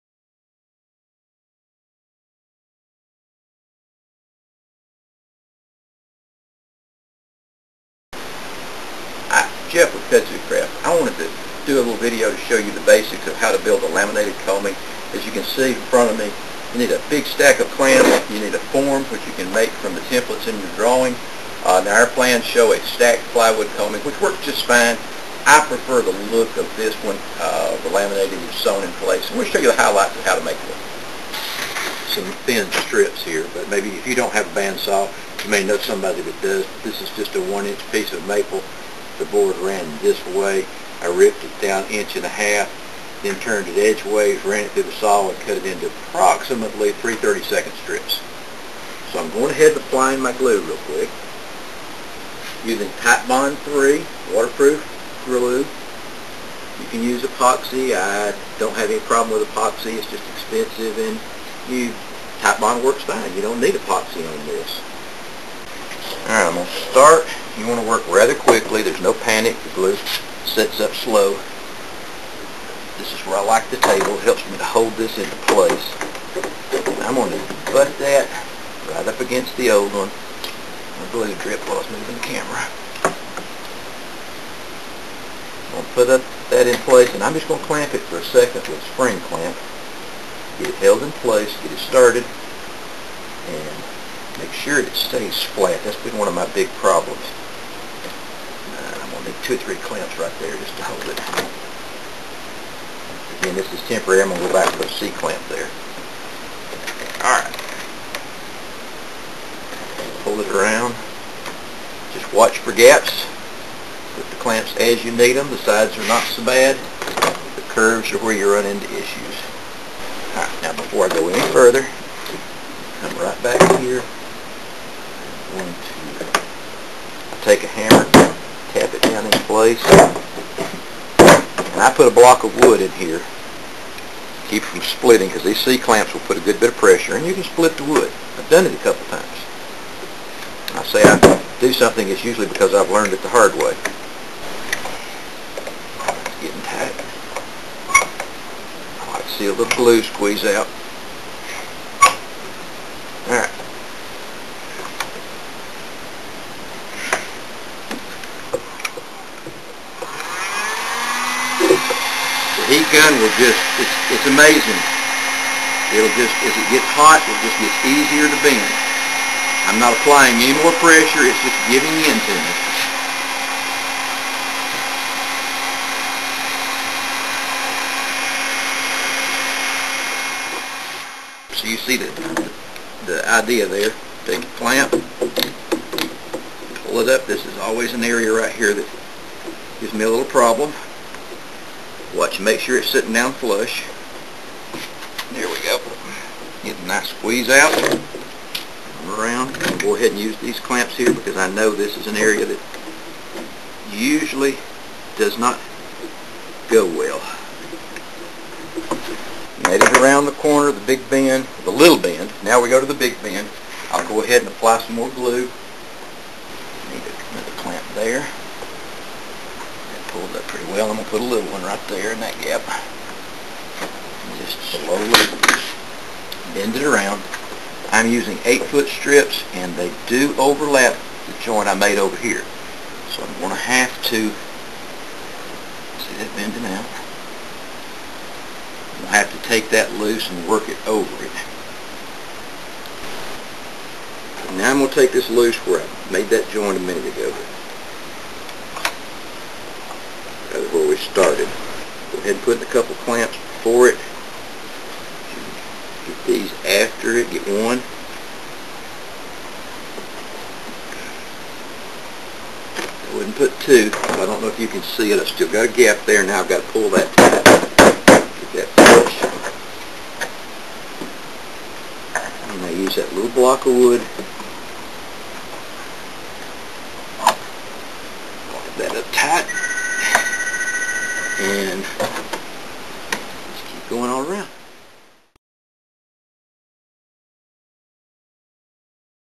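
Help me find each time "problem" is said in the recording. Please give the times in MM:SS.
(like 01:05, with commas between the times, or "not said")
00:59, 01:36, 03:10.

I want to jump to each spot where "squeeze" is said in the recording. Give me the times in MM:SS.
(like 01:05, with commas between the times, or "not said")
02:30, 03:17.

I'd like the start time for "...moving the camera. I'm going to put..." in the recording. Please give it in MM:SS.
01:21.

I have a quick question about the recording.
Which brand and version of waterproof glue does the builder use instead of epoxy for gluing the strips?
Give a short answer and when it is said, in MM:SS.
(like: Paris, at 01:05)
Titebond 3, at 00:53.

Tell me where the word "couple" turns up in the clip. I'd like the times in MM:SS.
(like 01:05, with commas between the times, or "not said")
02:18, 04:12.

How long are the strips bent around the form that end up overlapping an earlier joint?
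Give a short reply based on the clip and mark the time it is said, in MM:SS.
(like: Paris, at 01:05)
8-foot, at 03:48.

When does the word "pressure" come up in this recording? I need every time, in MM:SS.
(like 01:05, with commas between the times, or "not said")
02:16, 02:50.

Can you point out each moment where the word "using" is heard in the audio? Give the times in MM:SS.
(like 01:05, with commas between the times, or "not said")
00:52, 03:48.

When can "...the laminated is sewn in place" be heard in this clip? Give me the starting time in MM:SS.
00:27.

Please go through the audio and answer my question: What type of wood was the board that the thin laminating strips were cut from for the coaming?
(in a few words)
maple.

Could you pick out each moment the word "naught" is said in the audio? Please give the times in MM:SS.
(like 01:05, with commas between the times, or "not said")
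not said.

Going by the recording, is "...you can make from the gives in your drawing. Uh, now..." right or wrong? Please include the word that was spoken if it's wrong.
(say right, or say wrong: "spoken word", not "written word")
wrong: "templates", not "gives".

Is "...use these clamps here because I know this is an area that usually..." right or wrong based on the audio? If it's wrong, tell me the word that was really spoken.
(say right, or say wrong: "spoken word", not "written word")
right.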